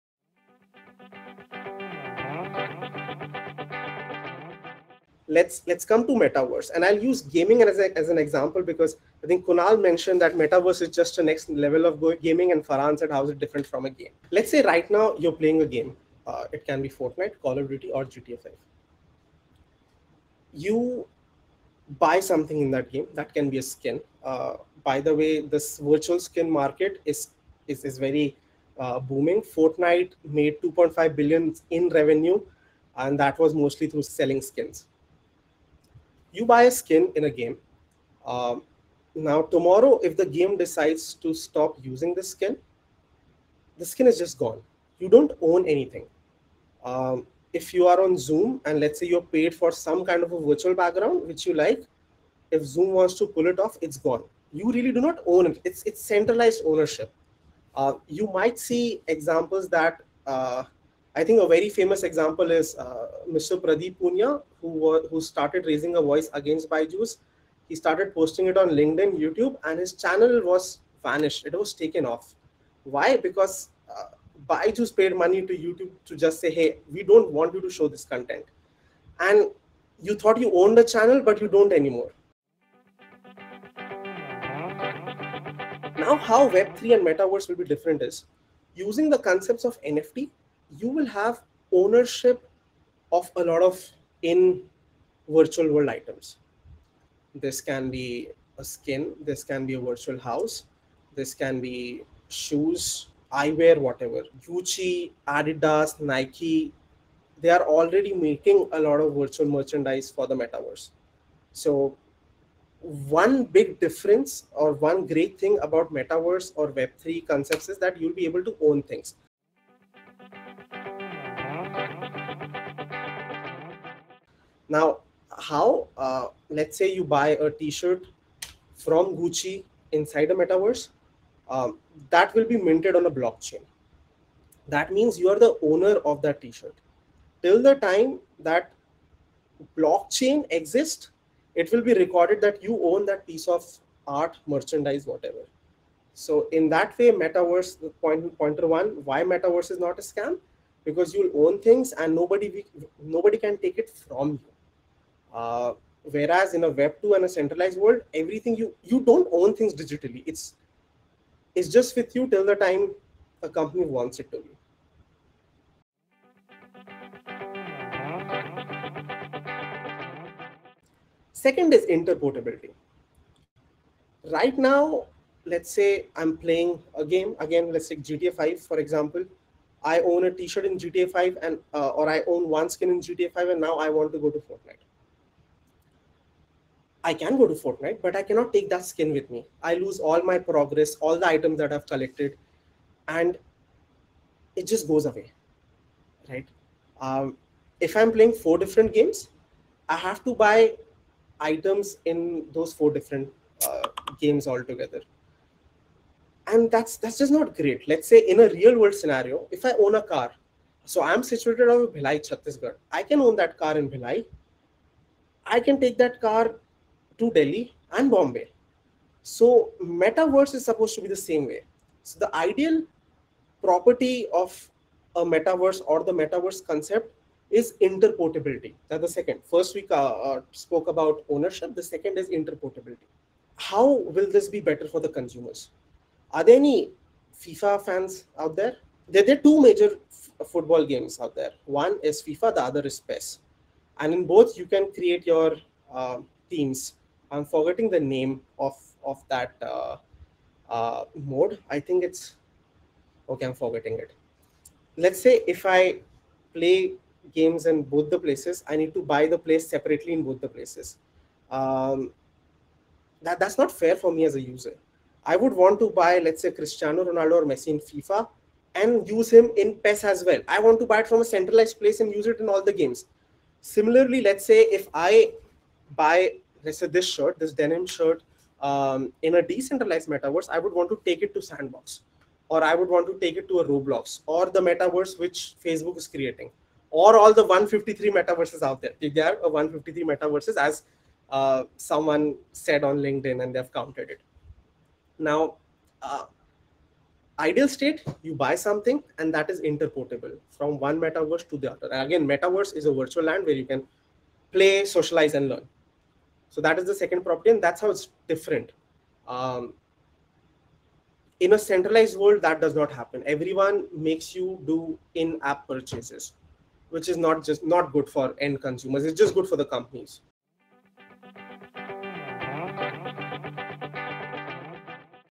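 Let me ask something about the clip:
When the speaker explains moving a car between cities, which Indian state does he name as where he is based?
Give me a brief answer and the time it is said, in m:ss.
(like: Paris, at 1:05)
Chhattisgarh, at 3:32.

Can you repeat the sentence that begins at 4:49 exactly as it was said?
There are 153 metaverses, as uh, someone said on LinkedIn, and they've counted it.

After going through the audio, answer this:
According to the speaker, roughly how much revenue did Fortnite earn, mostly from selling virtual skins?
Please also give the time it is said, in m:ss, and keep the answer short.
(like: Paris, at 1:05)
2.5 billion, at 0:30.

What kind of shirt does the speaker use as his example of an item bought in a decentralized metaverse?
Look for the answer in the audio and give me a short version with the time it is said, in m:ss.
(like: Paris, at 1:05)
Denim shirt, at 4:37.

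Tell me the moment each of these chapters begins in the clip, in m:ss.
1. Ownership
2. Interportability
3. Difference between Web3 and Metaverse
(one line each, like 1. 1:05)
1. 2:00
2. 2:47
3. 1:23.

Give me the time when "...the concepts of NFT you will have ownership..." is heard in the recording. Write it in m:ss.
1:29.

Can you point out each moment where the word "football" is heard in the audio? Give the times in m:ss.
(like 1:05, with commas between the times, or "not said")
4:00.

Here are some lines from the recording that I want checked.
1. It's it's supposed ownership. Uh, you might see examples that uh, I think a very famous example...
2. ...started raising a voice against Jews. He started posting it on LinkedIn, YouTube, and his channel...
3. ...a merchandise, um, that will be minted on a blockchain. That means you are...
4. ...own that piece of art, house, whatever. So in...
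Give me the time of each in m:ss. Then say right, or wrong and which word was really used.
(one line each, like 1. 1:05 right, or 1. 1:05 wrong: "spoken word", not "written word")
1. 0:55 wrong: "centralized", not "supposed"
2. 1:05 right
3. 2:10 wrong: "metaverse", not "merchandise"
4. 2:22 wrong: "merchandise", not "house".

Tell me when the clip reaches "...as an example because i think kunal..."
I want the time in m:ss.
0:07.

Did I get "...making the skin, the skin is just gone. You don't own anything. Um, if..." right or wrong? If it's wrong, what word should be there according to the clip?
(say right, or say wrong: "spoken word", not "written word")
wrong: "using", not "making".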